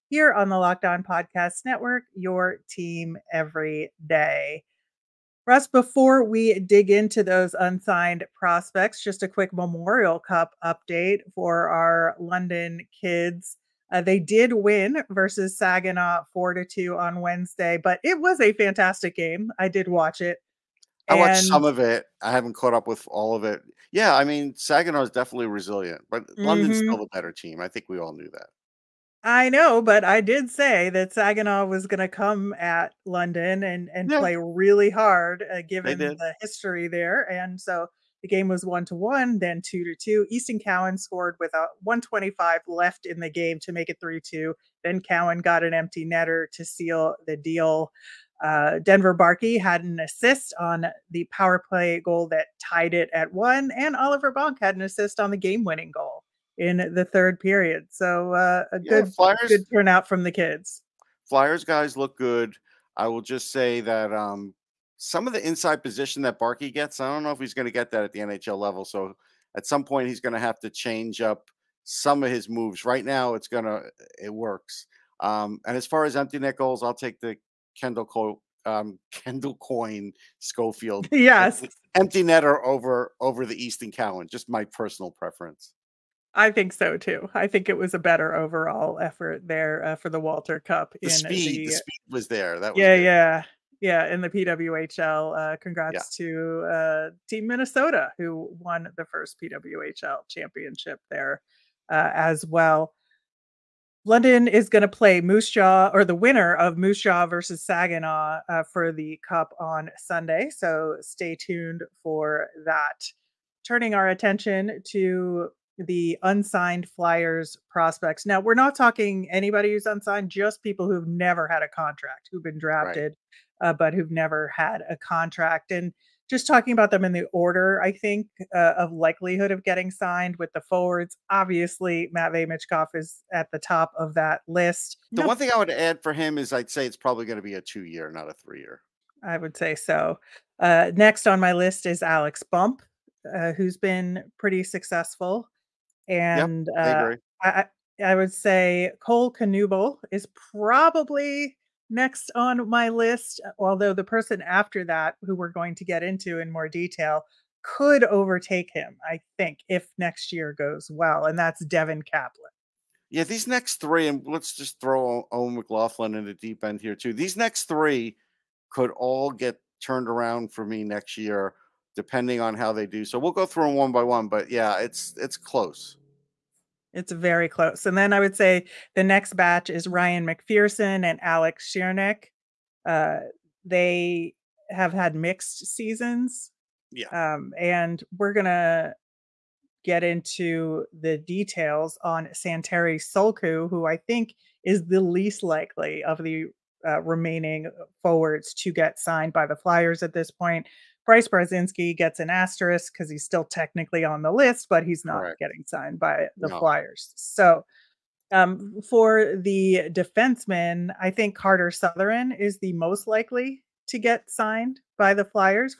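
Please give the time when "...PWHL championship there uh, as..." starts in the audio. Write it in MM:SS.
01:39.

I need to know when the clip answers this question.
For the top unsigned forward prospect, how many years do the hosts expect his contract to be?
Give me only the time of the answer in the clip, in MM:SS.
02:17.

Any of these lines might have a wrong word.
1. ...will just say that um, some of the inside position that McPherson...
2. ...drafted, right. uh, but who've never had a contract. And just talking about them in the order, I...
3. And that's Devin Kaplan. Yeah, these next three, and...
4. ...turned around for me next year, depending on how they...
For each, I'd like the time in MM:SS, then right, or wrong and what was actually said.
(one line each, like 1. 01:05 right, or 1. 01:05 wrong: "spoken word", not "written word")
1. 01:03 wrong: "Barkey", not "McPherson"
2. 02:02 right
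3. 02:41 right
4. 02:49 right.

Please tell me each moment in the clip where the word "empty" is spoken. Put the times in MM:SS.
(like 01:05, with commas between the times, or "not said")
00:45, 01:16, 01:21.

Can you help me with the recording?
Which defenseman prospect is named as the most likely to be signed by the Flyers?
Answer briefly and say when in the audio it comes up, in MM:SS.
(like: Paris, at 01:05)
Carter Sutherland, at 03:31.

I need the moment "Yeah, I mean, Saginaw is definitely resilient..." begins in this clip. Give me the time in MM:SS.
00:23.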